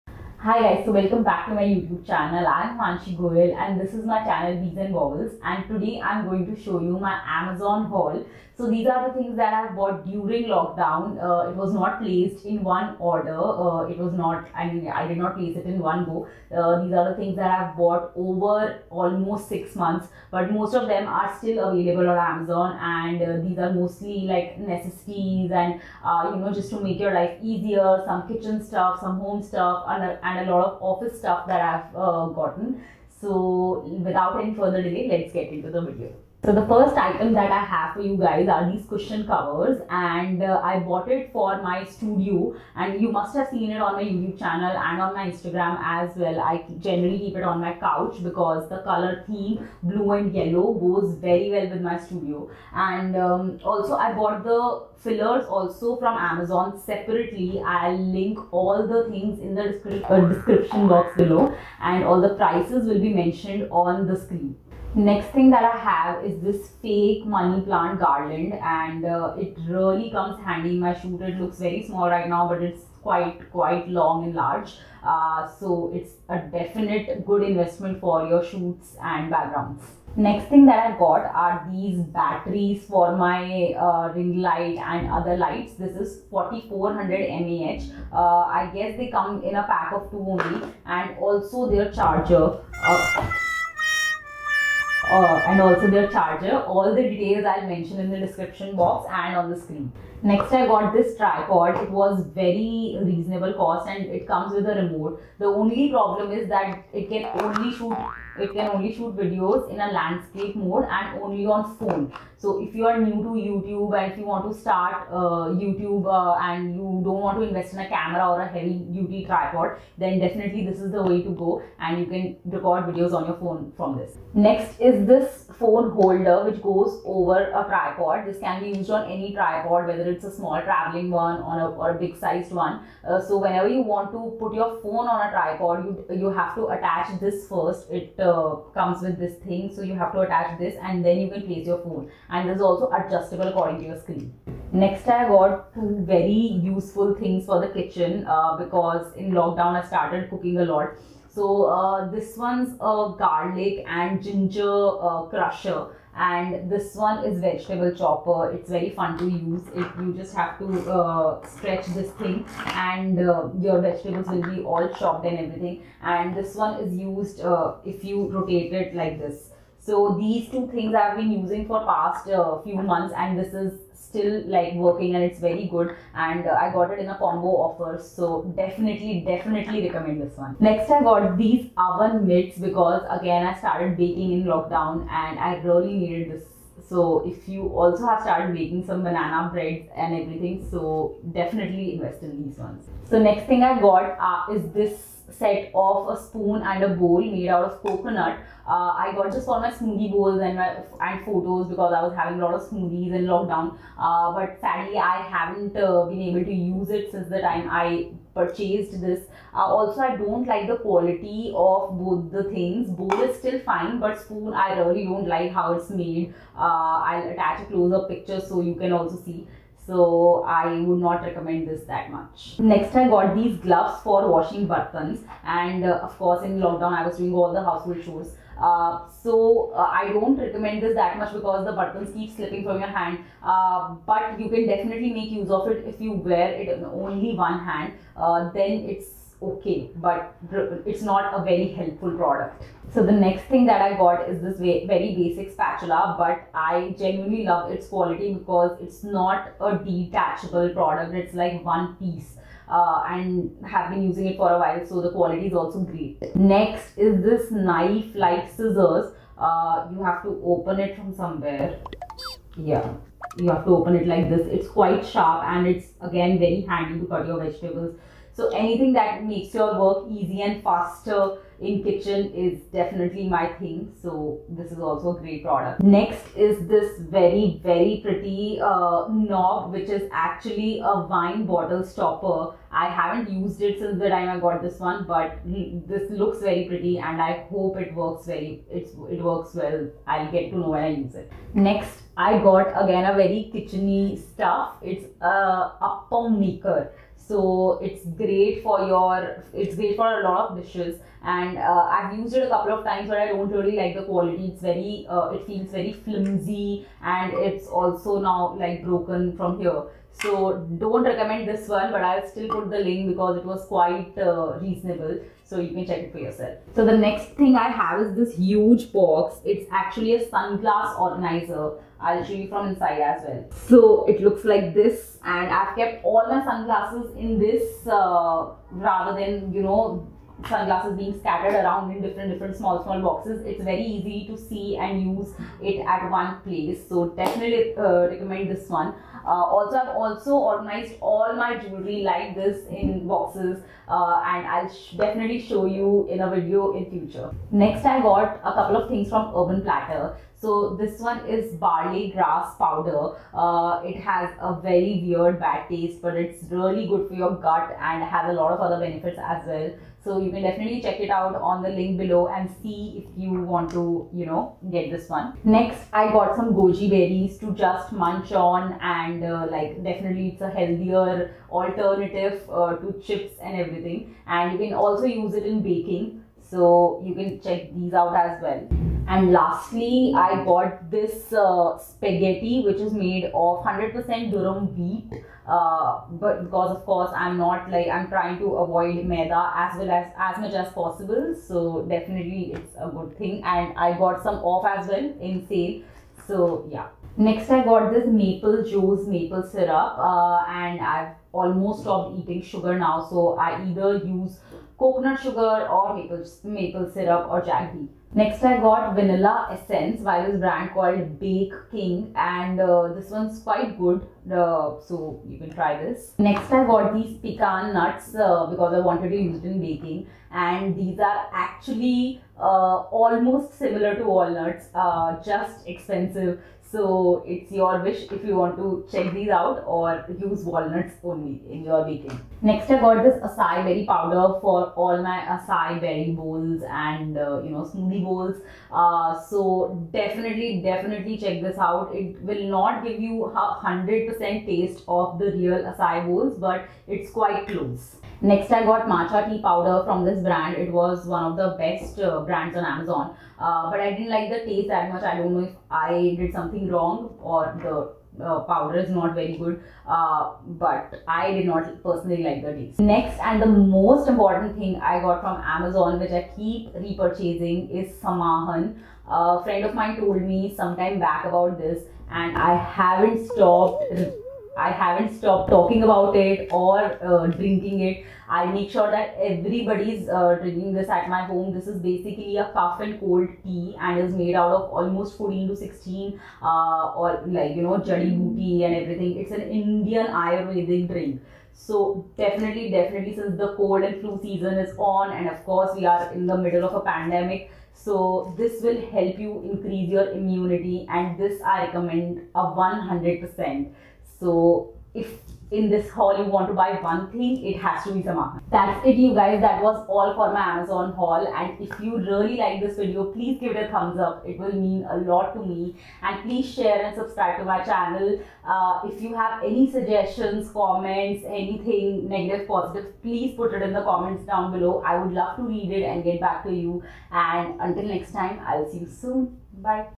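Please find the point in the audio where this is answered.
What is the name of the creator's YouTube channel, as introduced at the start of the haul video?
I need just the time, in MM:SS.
00:04.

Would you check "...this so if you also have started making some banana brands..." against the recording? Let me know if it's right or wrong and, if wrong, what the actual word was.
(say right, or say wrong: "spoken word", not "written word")
wrong: "breads", not "brands".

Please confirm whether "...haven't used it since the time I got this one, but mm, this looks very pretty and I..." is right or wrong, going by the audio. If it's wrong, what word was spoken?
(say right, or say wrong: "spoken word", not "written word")
right.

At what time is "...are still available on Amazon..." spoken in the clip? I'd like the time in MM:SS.
00:21.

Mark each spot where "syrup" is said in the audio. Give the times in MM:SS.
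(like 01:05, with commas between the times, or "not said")
06:39, 06:46.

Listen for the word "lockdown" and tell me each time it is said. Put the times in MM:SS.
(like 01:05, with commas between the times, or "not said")
00:10, 02:29, 03:04, 03:23, 03:46.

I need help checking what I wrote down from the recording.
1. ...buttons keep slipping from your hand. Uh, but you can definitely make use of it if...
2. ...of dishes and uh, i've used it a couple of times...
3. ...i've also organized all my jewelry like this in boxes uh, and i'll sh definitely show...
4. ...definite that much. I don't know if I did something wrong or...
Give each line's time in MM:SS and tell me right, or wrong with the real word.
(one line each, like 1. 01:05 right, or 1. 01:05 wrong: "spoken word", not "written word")
1. 03:51 right
2. 05:00 right
3. 05:39 right
4. 07:34 wrong: "taste", not "definite".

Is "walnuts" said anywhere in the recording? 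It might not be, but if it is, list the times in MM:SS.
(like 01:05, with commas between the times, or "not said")
07:04, 07:10.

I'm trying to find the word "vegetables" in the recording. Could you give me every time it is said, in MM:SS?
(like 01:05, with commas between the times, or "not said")
02:37, 02:43, 04:27.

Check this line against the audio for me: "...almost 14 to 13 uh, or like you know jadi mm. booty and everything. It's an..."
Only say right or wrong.
wrong.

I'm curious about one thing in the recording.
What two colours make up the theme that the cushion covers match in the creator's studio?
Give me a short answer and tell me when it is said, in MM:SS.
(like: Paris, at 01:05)
blue and yellow, at 00:49.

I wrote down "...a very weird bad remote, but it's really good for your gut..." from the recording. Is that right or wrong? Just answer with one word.
wrong.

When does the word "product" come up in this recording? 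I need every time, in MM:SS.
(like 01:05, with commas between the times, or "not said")
04:02, 04:10, 04:35.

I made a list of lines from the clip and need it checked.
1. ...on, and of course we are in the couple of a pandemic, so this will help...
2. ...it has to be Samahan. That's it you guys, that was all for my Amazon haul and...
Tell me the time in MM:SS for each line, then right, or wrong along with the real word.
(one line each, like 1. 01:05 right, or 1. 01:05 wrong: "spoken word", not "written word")
1. 08:14 wrong: "middle", not "couple"
2. 08:27 right.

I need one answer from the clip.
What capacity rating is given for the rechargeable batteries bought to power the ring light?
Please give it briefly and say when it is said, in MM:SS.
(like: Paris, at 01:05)
4400 mAh, at 01:26.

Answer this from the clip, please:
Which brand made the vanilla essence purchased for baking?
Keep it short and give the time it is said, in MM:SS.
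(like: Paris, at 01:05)
Bake King, at 06:51.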